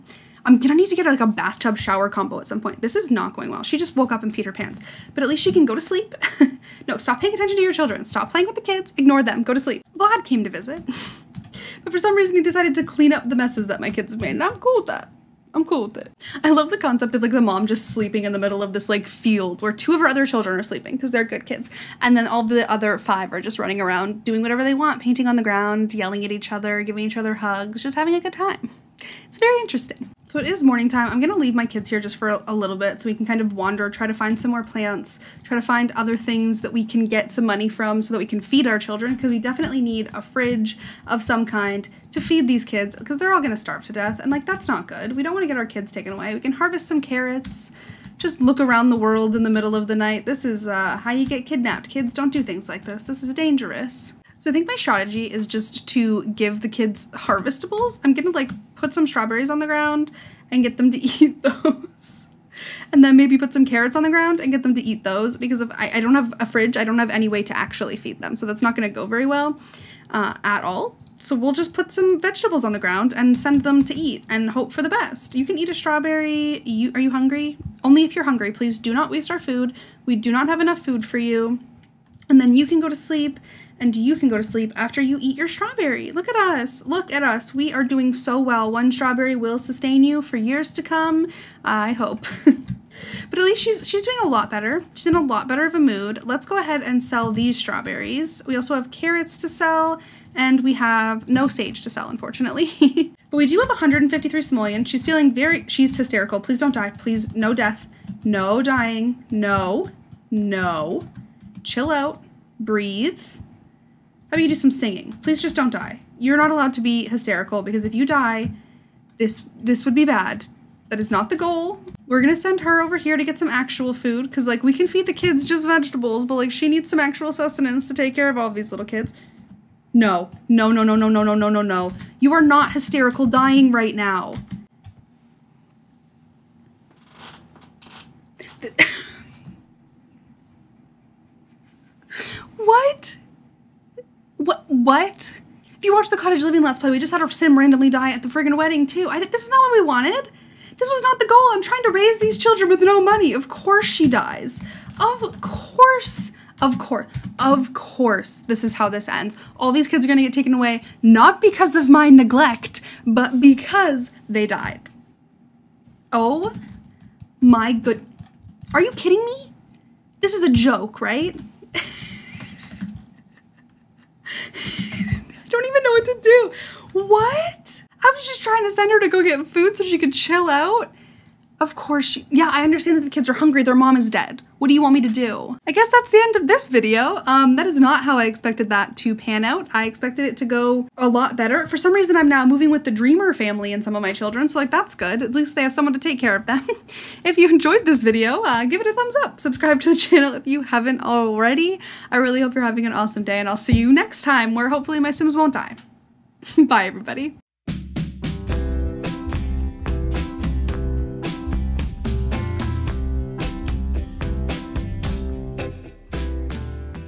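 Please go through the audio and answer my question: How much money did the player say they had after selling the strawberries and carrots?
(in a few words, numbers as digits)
153 simoleons.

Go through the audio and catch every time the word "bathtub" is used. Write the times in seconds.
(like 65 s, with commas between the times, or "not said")
1 s.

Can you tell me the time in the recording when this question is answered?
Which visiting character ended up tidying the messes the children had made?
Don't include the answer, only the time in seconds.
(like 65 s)
9 s.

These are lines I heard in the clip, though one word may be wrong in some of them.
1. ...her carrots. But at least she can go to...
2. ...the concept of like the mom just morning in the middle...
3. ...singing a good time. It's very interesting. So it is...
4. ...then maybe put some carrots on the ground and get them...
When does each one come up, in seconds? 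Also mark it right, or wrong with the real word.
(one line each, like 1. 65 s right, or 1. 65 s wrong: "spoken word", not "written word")
1. 4 s wrong: "pants", not "carrots"
2. 16 s wrong: "sleeping", not "morning"
3. 27 s wrong: "having", not "singing"
4. 63 s right.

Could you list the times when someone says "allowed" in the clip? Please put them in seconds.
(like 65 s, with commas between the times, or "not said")
116 s.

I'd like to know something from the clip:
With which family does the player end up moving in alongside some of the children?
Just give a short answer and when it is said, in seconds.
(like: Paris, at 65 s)
the Dreamer family, at 192 s.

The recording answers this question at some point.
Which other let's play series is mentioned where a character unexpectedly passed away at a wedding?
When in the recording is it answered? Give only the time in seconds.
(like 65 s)
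146 s.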